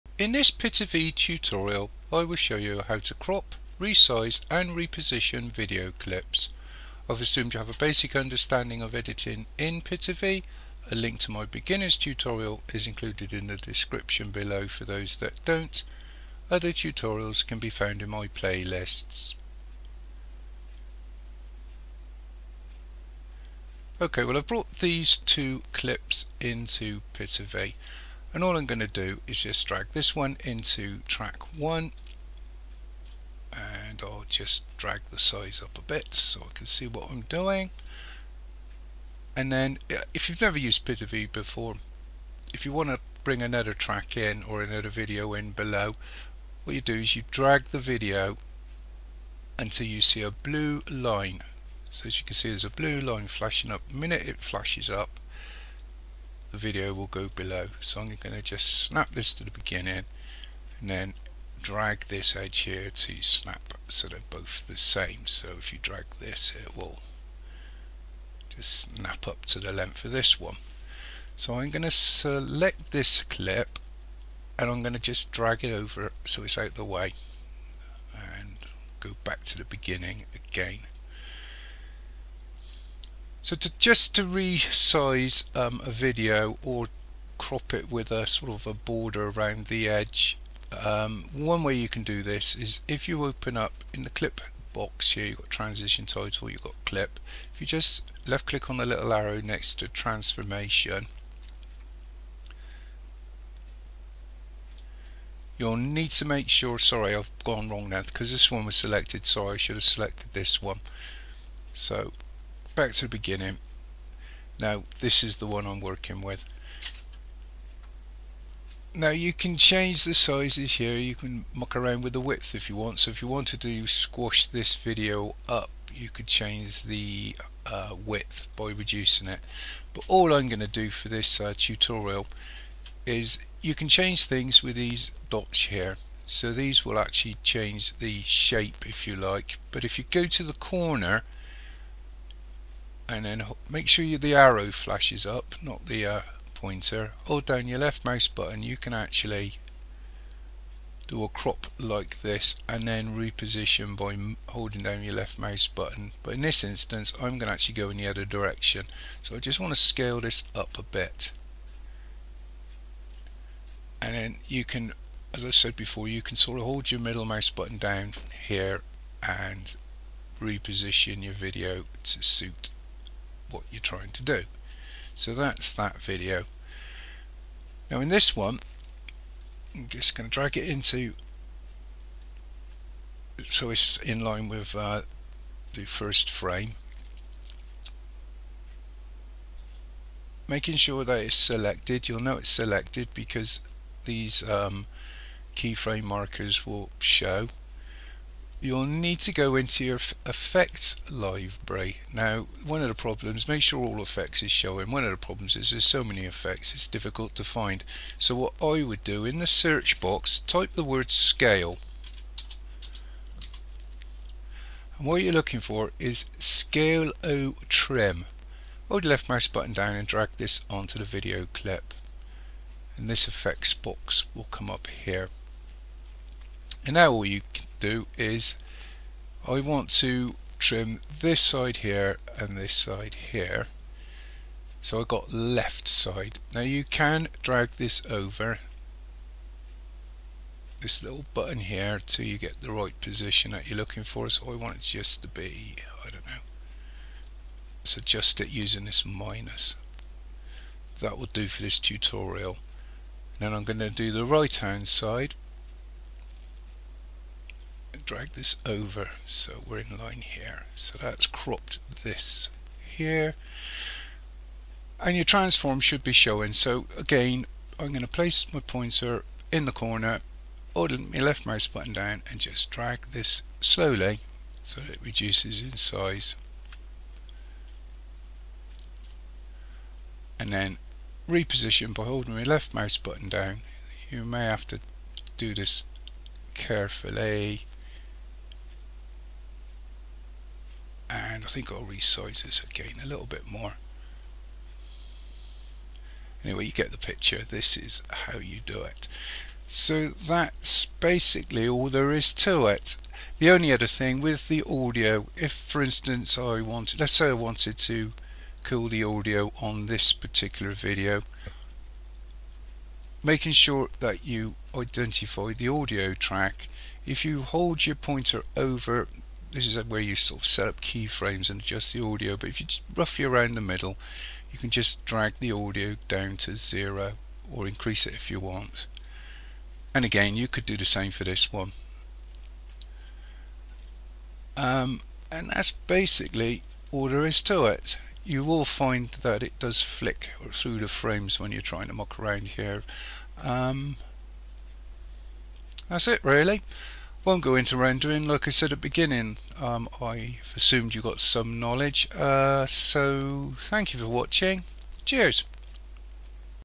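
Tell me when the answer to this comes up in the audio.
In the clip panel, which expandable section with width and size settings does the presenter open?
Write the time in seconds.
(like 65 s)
99 s.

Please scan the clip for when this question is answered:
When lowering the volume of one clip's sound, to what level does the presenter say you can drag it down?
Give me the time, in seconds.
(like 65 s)
326 s.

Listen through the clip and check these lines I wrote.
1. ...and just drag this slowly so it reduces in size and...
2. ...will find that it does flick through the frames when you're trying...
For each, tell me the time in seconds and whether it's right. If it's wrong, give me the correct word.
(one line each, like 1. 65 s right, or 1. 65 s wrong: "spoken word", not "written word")
1. 272 s right
2. 338 s right.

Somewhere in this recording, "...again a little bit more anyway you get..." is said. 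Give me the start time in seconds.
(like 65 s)
292 s.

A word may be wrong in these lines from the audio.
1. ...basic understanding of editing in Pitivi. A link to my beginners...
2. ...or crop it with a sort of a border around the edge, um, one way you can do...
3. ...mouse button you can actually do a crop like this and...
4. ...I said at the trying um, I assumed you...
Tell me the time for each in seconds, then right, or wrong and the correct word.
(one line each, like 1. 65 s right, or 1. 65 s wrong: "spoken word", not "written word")
1. 7 s right
2. 86 s right
3. 148 s right
4. 348 s wrong: "beginning", not "trying".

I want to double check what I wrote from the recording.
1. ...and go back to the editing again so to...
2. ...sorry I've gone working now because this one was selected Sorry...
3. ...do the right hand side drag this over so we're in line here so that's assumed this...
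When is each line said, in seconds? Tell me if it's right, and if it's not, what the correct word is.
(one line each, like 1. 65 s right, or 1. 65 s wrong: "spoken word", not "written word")
1. 78 s wrong: "beginning", not "editing"
2. 106 s wrong: "wrong", not "working"
3. 253 s wrong: "cropped", not "assumed".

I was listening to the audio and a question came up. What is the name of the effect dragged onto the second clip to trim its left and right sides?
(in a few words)
scale O trim.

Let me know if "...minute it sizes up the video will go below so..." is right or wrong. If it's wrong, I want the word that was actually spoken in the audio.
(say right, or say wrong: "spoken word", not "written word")
wrong: "flashes", not "sizes".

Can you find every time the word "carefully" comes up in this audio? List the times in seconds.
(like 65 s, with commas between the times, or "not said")
286 s.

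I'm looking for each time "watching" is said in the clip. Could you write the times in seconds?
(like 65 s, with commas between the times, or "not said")
354 s.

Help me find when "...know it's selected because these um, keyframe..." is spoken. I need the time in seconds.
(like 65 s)
192 s.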